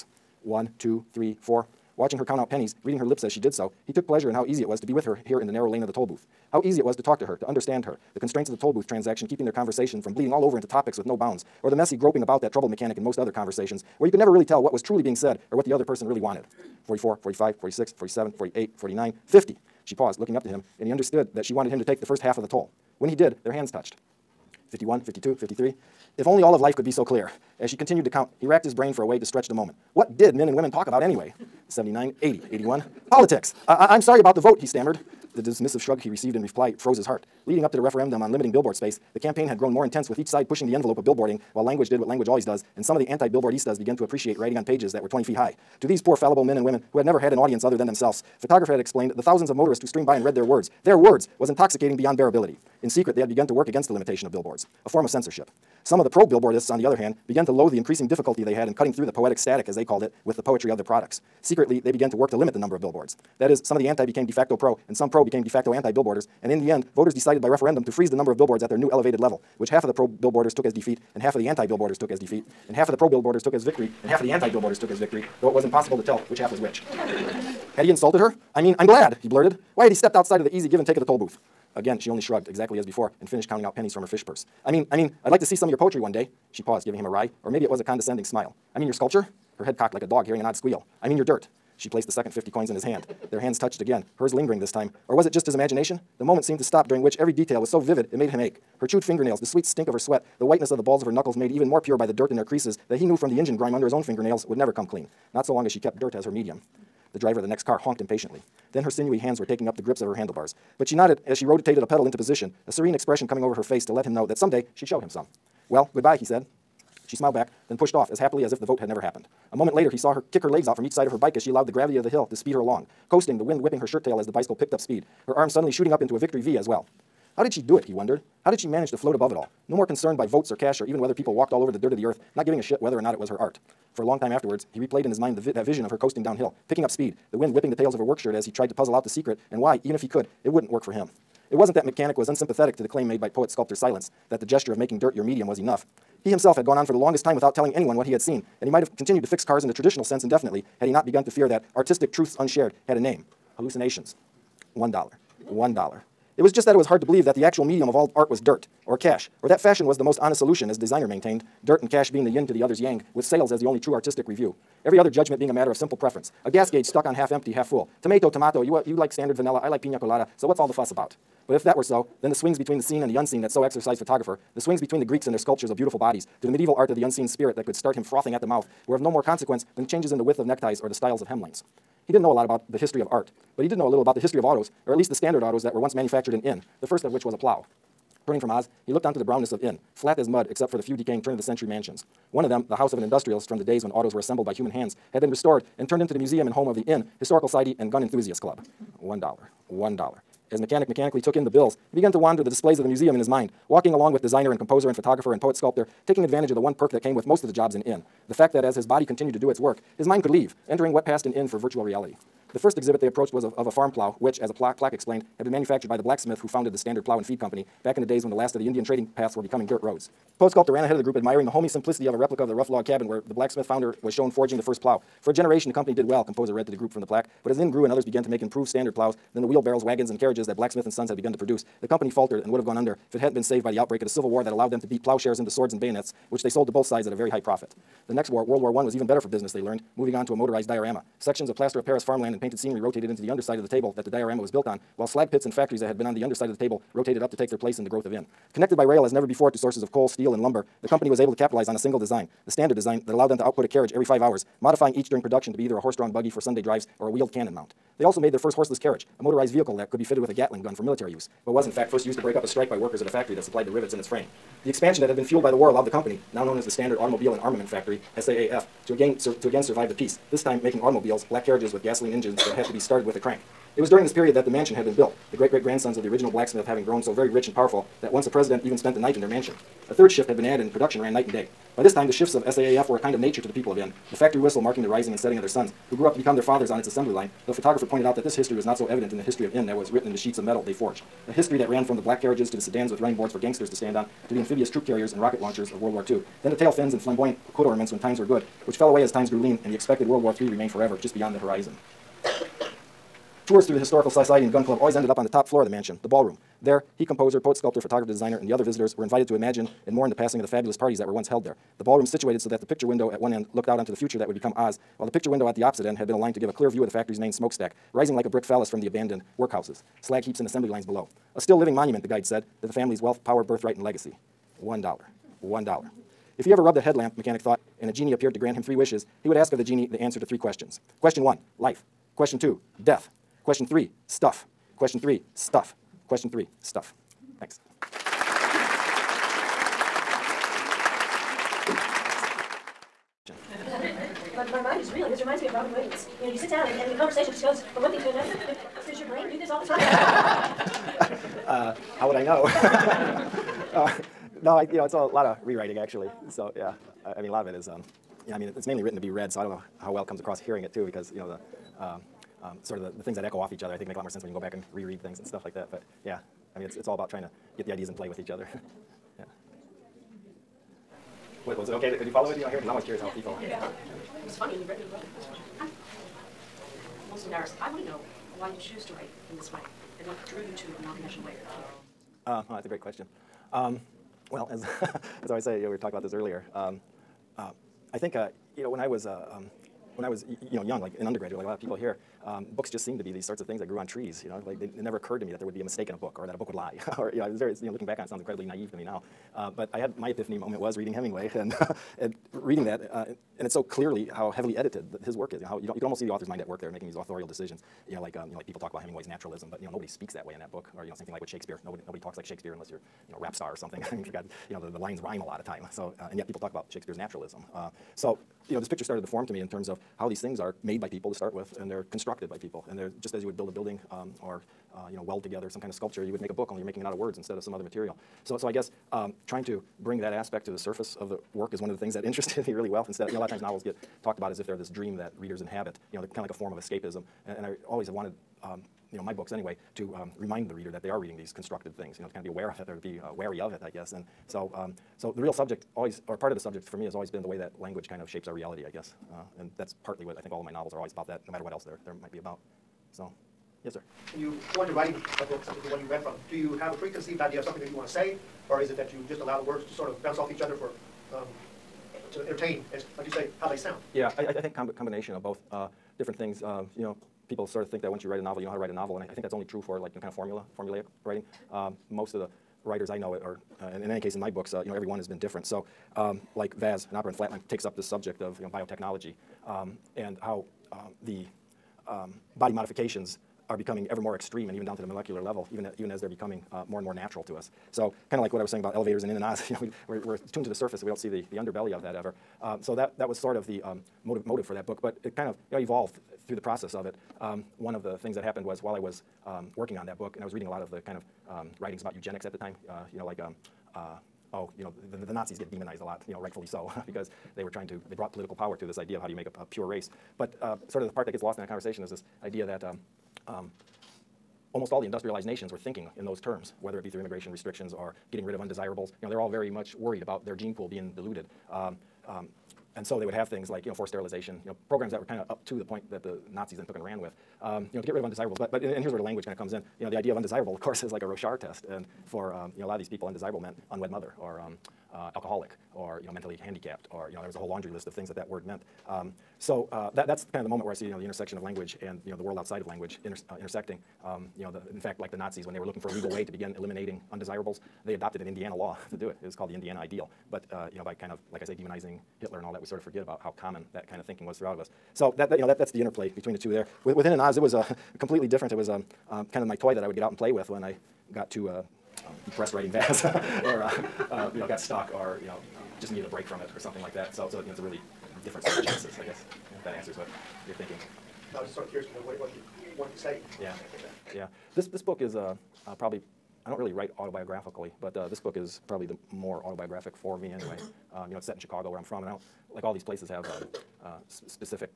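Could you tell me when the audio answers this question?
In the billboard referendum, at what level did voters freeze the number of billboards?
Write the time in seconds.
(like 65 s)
68 s.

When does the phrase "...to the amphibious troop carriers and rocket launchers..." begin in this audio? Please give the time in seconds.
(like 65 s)
294 s.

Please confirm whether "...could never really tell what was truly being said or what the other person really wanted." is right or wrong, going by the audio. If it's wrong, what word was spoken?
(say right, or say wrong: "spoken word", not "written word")
right.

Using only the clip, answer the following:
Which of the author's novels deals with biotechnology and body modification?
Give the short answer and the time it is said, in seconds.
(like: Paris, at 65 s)
VAS, an opera in Flatland, at 476 s.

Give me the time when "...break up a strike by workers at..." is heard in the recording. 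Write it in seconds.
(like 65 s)
262 s.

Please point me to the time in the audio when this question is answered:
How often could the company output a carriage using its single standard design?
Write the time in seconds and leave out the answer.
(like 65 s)
253 s.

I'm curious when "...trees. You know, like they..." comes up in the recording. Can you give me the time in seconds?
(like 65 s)
393 s.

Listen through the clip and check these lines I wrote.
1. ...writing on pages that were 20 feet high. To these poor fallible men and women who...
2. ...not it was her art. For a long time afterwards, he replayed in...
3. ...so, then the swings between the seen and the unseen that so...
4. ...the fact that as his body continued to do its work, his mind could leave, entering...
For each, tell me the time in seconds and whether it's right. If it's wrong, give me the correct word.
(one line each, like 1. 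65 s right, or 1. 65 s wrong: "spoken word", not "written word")
1. 44 s right
2. 132 s right
3. 171 s right
4. 208 s right.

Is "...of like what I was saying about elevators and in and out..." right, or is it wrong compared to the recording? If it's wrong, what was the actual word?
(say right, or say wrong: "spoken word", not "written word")
right.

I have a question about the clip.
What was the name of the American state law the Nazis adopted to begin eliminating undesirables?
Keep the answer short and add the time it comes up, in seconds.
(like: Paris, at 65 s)
The Indiana Ideal, at 549 s.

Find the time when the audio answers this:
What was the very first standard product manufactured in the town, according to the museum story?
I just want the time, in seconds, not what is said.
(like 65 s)
187 s.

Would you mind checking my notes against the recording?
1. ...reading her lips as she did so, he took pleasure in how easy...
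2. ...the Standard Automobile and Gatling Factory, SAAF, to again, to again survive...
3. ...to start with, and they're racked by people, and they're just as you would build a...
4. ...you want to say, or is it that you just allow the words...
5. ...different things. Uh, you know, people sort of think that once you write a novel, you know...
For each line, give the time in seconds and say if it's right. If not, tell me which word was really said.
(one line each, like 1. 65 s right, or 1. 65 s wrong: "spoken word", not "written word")
1. 2 s right
2. 266 s wrong: "Armament", not "Gatling"
3. 421 s wrong: "constructed", not "racked"
4. 457 s right
5. 465 s right.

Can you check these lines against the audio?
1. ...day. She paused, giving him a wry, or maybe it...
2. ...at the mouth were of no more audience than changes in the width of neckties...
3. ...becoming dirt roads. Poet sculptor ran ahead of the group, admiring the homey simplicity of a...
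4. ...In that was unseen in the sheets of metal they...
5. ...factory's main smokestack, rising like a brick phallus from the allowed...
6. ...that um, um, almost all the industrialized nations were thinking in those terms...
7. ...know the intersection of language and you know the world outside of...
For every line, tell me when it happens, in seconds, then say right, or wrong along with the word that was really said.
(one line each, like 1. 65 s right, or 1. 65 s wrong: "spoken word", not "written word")
1. 86 s right
2. 178 s wrong: "consequence", not "audience"
3. 219 s right
4. 289 s wrong: "written", not "unseen"
5. 316 s wrong: "abandoned", not "allowed"
6. 512 s right
7. 540 s right.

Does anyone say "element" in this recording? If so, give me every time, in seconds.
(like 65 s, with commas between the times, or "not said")
not said.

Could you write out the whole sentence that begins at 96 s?
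The moment seemed to stop during which every detail was so vivid it made him ache.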